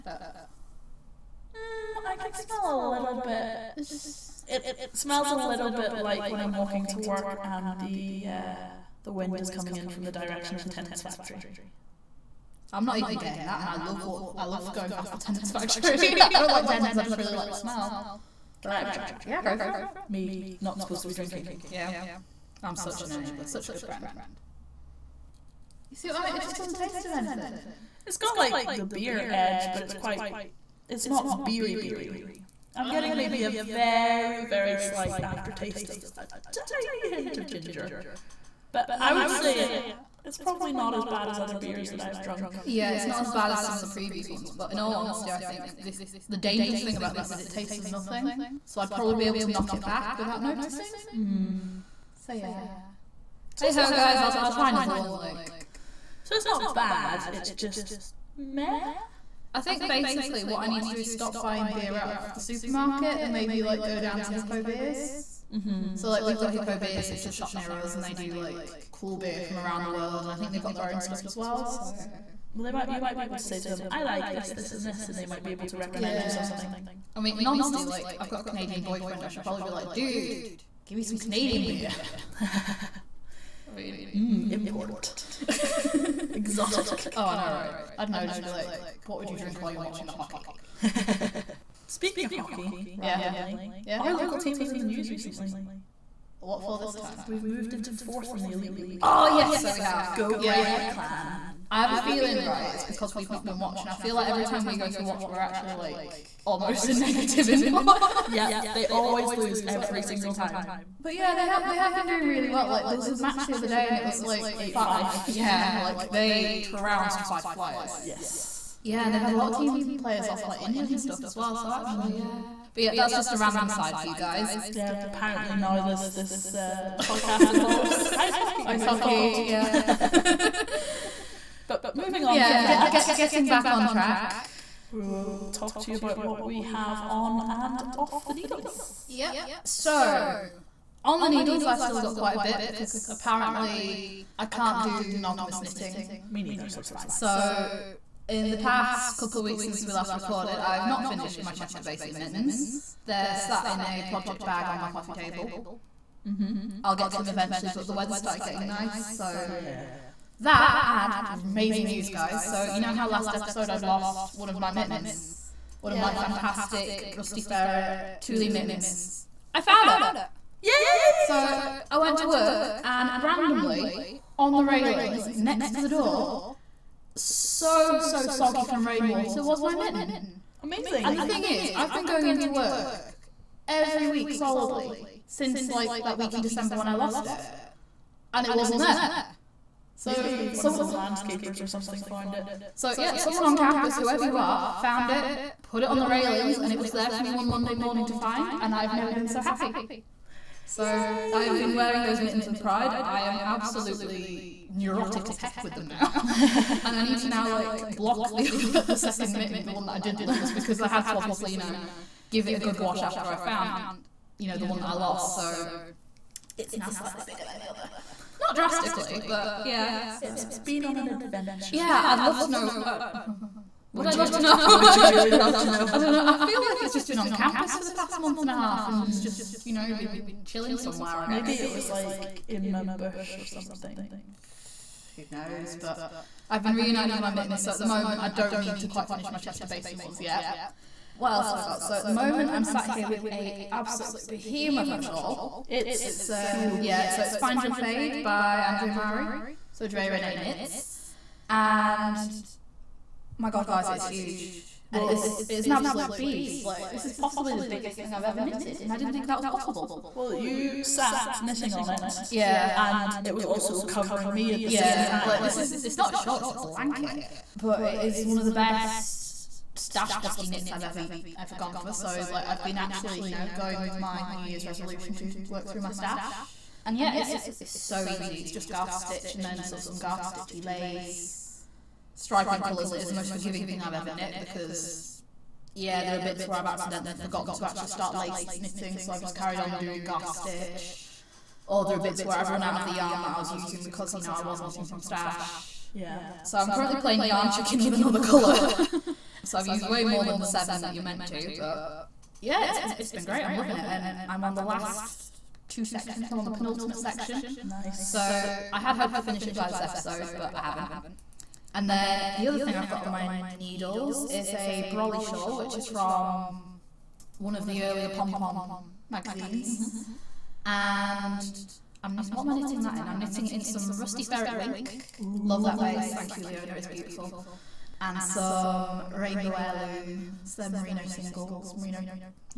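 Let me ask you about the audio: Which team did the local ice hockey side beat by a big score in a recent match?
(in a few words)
Fife Flyers.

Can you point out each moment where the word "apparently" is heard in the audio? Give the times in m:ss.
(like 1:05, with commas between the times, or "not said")
2:05, 2:23.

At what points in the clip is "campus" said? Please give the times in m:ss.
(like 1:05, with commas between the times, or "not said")
3:13, 3:47.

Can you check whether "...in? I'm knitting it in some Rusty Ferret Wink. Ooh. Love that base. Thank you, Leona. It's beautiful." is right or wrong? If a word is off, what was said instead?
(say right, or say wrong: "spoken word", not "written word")
right.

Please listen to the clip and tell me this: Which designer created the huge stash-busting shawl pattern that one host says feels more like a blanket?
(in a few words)
Andrea Mowry.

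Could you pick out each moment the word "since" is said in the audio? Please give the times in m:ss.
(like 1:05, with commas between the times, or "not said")
2:29, 3:05.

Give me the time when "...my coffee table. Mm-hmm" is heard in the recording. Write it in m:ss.
2:34.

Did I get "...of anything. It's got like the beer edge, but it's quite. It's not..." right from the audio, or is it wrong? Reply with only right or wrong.
right.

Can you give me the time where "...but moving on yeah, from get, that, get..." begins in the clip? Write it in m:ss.
2:11.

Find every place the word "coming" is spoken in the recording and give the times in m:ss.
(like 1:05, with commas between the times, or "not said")
0:09.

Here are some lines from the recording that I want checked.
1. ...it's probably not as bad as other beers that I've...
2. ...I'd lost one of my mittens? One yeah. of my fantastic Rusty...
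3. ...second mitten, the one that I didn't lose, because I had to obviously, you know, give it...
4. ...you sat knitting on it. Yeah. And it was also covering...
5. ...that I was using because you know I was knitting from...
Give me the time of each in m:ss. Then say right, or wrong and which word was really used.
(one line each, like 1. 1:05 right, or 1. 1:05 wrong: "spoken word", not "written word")
1. 0:40 right
2. 2:43 right
3. 3:28 right
4. 4:20 right
5. 4:53 right.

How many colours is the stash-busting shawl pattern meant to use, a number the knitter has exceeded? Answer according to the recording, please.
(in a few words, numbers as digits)
7.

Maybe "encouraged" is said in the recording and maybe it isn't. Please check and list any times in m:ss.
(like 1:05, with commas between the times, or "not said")
not said.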